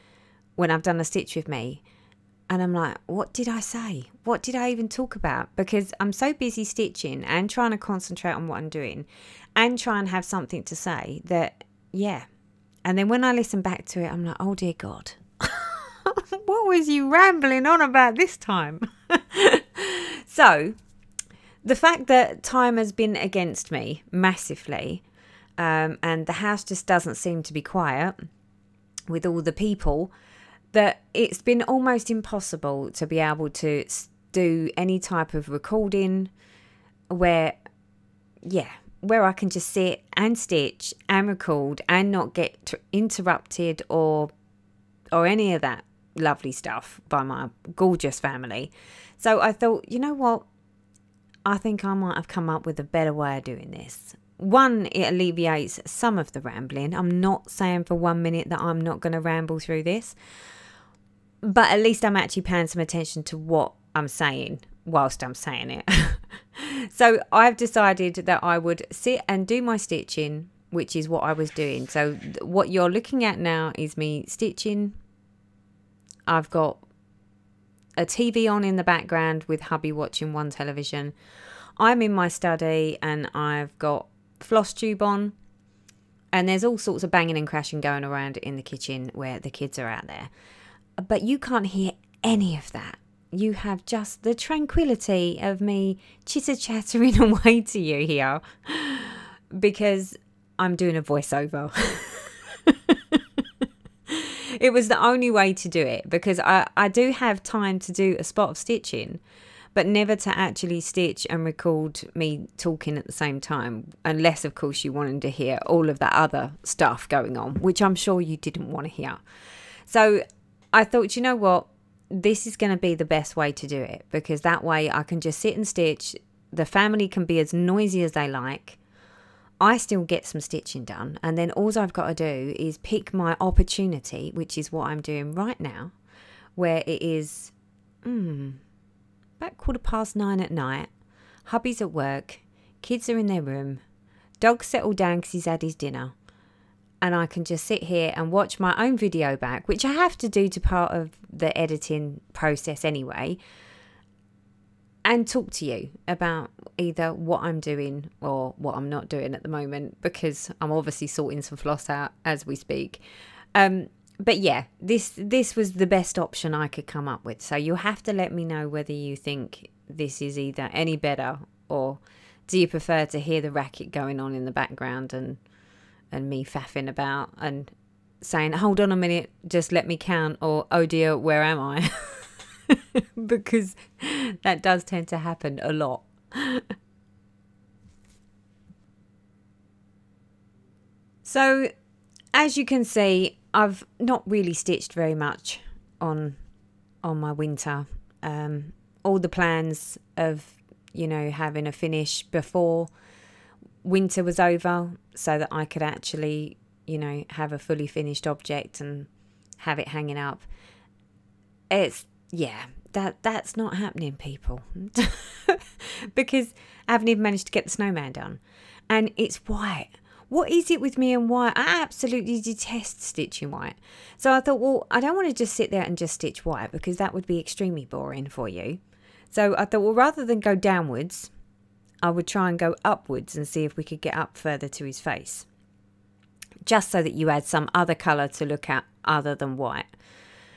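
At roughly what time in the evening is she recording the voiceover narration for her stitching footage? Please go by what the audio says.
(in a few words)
Quarter past nine.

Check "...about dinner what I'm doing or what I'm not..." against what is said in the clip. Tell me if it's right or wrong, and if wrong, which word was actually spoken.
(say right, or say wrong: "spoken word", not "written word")
wrong: "either", not "dinner".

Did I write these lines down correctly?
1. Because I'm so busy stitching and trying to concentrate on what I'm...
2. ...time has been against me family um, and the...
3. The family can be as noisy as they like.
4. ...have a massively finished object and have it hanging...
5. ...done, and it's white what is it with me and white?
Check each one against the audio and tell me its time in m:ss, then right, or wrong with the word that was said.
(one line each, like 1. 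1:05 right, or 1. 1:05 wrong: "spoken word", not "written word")
1. 0:05 right
2. 0:22 wrong: "massively", not "family"
3. 2:06 right
4. 3:27 wrong: "fully", not "massively"
5. 3:38 right.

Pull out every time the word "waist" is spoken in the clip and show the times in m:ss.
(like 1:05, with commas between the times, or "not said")
not said.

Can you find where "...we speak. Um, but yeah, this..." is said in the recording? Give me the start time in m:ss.
2:42.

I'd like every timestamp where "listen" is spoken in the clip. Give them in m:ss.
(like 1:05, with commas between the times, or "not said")
0:13.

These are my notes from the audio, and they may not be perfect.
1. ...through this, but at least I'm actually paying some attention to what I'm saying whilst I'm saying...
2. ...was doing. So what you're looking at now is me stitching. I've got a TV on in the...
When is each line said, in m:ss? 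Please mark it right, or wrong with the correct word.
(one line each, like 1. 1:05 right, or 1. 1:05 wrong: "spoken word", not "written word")
1. 0:59 right
2. 1:11 right.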